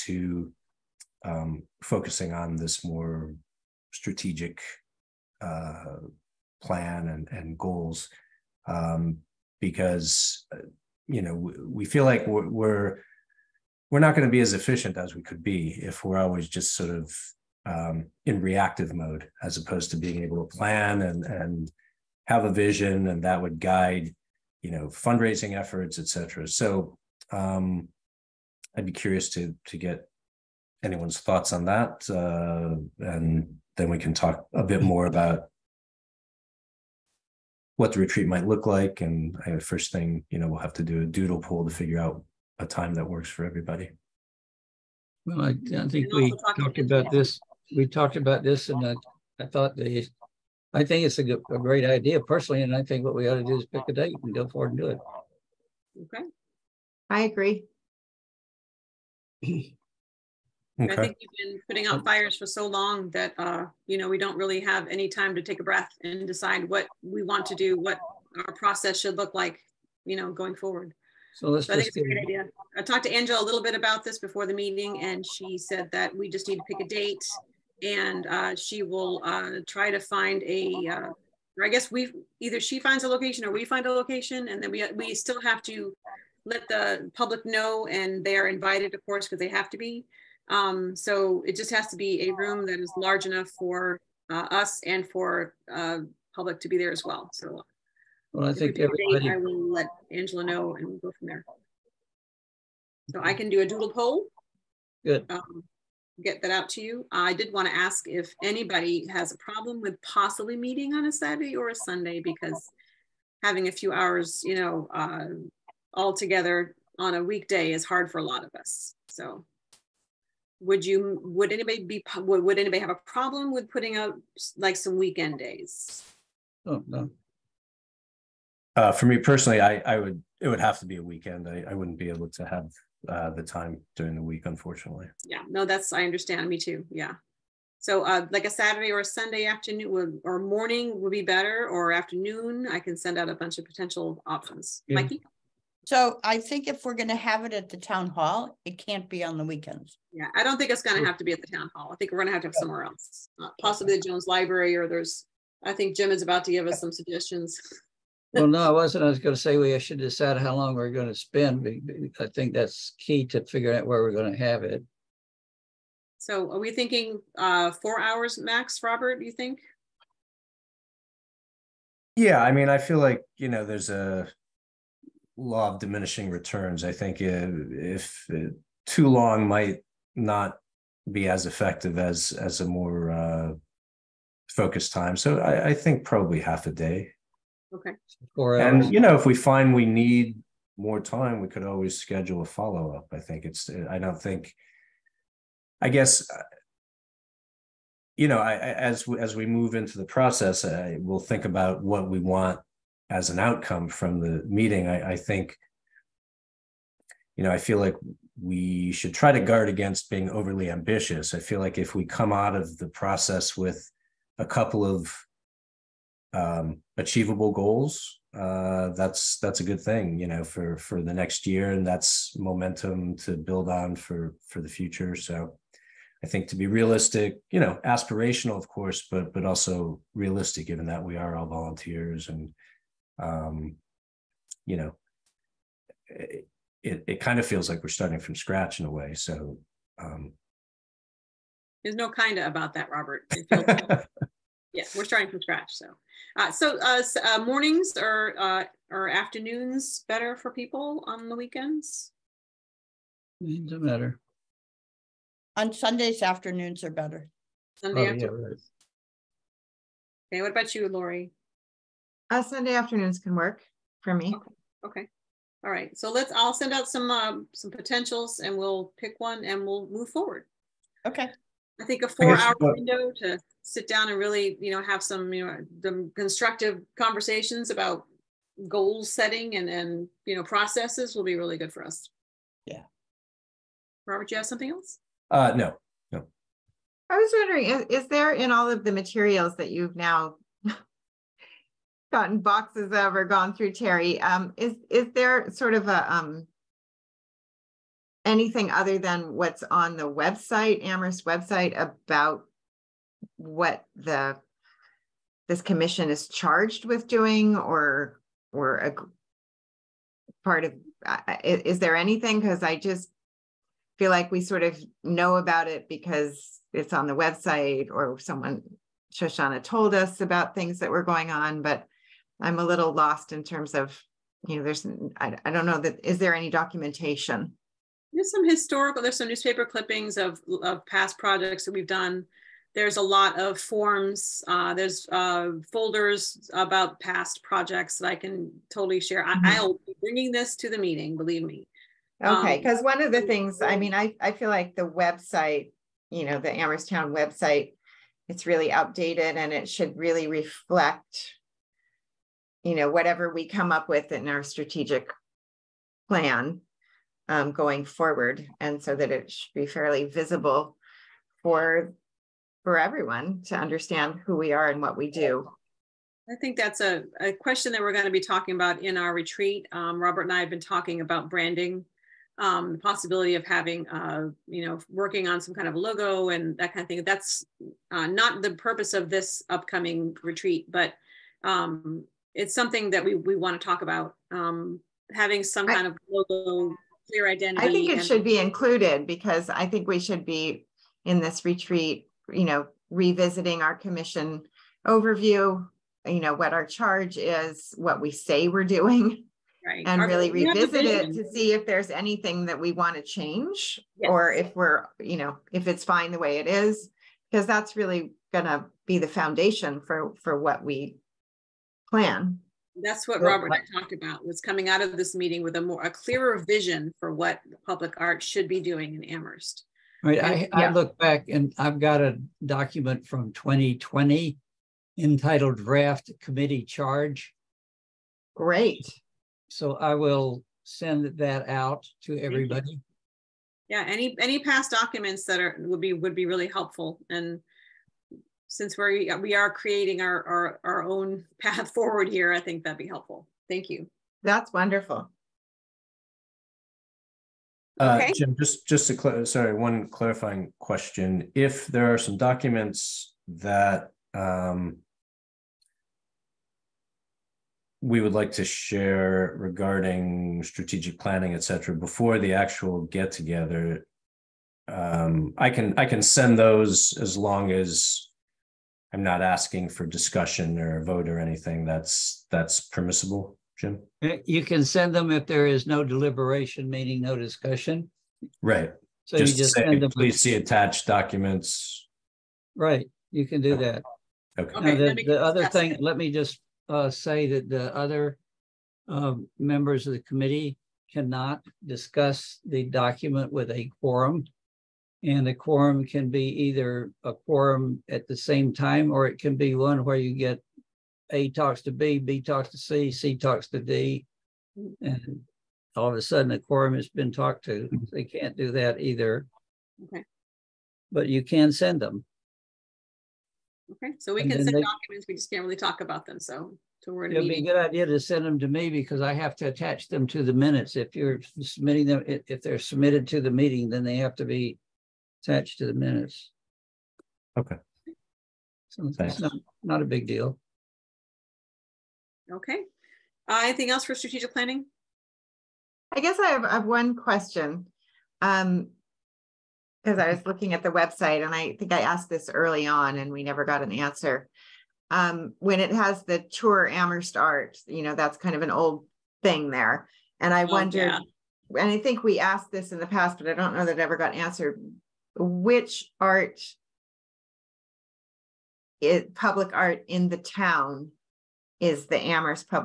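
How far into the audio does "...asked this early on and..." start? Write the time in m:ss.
9:01.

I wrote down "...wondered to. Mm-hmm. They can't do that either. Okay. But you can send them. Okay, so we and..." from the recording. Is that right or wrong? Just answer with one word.
wrong.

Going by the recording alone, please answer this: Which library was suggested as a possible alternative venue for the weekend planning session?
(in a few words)
Jones Library.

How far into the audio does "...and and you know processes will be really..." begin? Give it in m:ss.
4:39.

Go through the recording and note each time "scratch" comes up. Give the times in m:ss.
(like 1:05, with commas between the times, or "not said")
3:58, 4:05.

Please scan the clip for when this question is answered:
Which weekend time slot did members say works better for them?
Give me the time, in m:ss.
4:15.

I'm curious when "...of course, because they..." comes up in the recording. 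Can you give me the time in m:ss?
1:28.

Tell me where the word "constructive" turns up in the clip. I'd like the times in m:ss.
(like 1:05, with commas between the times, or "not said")
4:36.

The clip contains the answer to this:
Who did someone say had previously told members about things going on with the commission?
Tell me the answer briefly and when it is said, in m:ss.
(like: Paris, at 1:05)
Shoshana, at 5:19.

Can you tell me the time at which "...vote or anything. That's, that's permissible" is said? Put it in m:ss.
7:50.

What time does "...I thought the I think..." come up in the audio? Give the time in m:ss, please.
0:49.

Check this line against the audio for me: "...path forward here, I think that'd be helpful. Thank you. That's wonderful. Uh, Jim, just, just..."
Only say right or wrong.
right.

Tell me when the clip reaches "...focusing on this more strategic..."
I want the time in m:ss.
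0:01.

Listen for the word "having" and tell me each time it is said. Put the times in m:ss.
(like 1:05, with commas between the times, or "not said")
1:53, 6:13, 6:25.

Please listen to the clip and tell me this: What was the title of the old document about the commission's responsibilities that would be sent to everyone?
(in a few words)
Draft Committee Charge.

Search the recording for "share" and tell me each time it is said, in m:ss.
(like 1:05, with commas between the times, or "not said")
5:38, 7:38.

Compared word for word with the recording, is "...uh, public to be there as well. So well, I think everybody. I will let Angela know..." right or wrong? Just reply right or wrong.
right.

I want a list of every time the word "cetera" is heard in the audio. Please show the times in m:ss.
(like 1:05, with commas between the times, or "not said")
0:26, 7:41.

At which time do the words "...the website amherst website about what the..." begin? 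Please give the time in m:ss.
4:59.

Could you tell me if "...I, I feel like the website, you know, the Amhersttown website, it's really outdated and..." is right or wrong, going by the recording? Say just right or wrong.
right.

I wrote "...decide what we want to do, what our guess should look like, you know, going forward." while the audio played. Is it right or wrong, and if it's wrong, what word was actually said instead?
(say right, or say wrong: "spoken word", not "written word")
wrong: "process", not "guess".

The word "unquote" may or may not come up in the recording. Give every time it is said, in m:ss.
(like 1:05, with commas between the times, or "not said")
not said.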